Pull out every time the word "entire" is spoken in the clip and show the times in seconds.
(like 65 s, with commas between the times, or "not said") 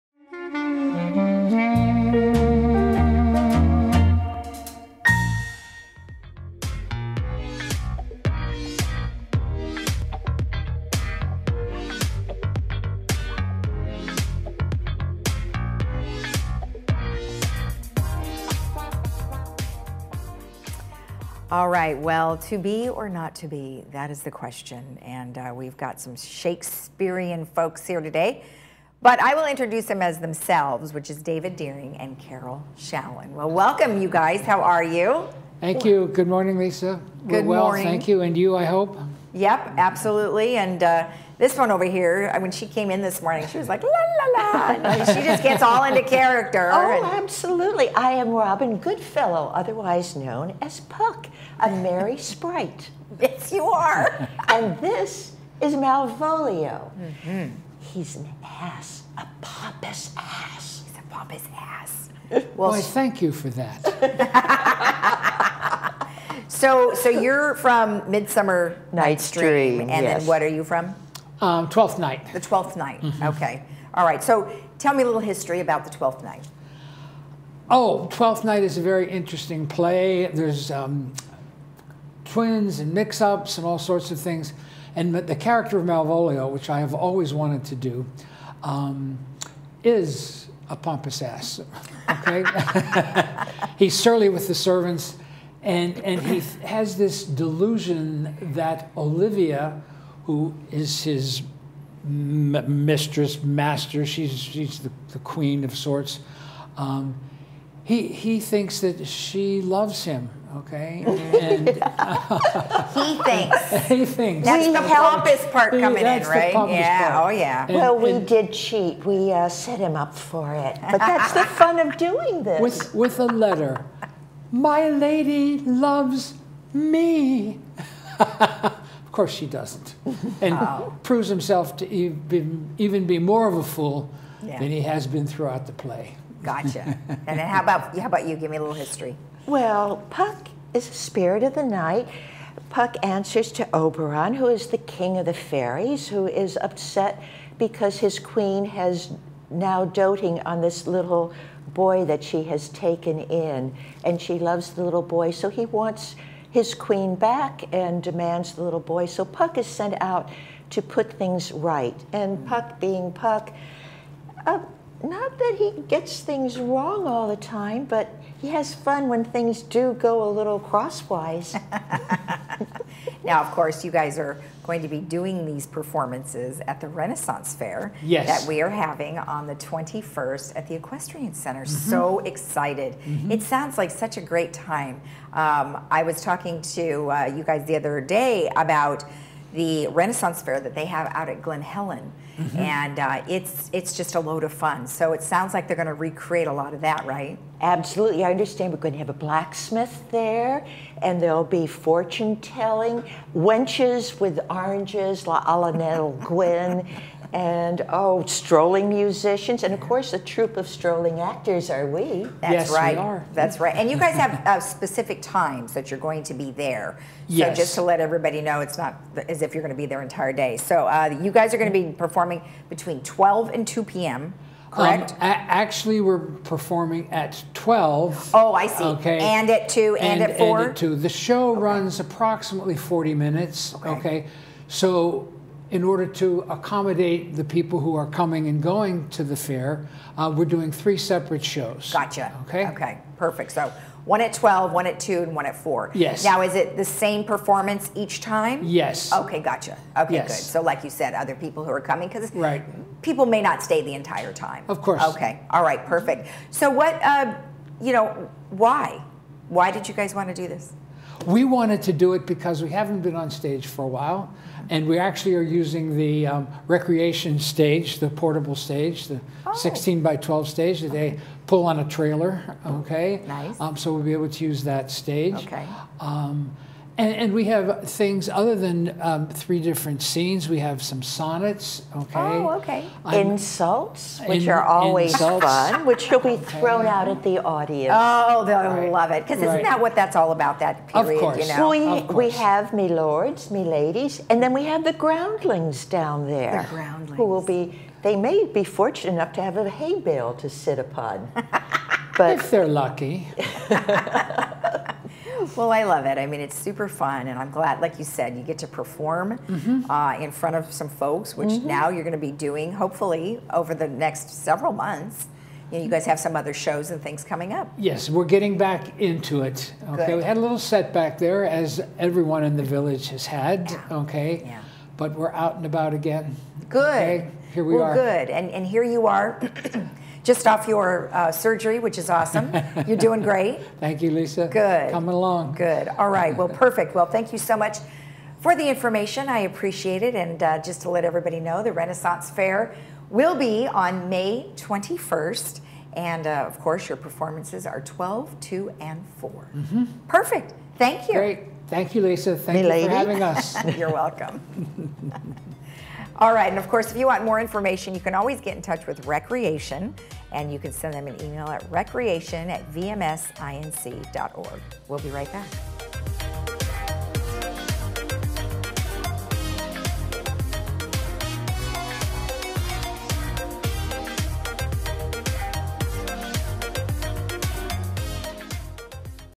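220 s, 253 s.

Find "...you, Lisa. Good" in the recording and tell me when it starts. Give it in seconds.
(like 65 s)
334 s.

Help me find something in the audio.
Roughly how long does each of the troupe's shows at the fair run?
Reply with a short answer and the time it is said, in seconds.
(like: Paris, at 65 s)
40 minutes, at 232 s.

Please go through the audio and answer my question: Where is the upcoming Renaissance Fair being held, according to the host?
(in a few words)
The Equestrian Center.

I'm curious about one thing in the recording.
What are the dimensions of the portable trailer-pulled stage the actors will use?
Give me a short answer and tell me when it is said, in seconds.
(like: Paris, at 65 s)
16 by 12, at 269 s.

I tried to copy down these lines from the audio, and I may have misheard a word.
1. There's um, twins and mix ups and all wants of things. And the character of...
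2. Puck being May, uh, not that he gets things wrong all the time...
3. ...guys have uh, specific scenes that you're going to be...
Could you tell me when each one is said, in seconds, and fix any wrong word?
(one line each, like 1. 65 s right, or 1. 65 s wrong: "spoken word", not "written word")
1. 80 s wrong: "sorts", not "wants"
2. 162 s wrong: "Puck", not "May"
3. 213 s wrong: "times", not "scenes".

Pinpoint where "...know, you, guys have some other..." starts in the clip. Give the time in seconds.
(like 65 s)
315 s.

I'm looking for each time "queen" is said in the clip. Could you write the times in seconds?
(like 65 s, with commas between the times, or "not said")
105 s, 148 s, 156 s.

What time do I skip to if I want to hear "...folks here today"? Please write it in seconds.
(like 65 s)
27 s.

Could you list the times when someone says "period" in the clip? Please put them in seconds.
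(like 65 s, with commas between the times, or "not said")
290 s.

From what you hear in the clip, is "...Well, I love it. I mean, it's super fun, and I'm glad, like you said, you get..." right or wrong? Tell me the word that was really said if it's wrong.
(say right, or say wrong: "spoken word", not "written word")
right.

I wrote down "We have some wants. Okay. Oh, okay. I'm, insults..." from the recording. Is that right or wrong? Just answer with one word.
wrong.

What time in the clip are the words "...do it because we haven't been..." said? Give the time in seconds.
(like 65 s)
261 s.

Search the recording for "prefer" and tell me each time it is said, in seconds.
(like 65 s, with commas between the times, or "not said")
not said.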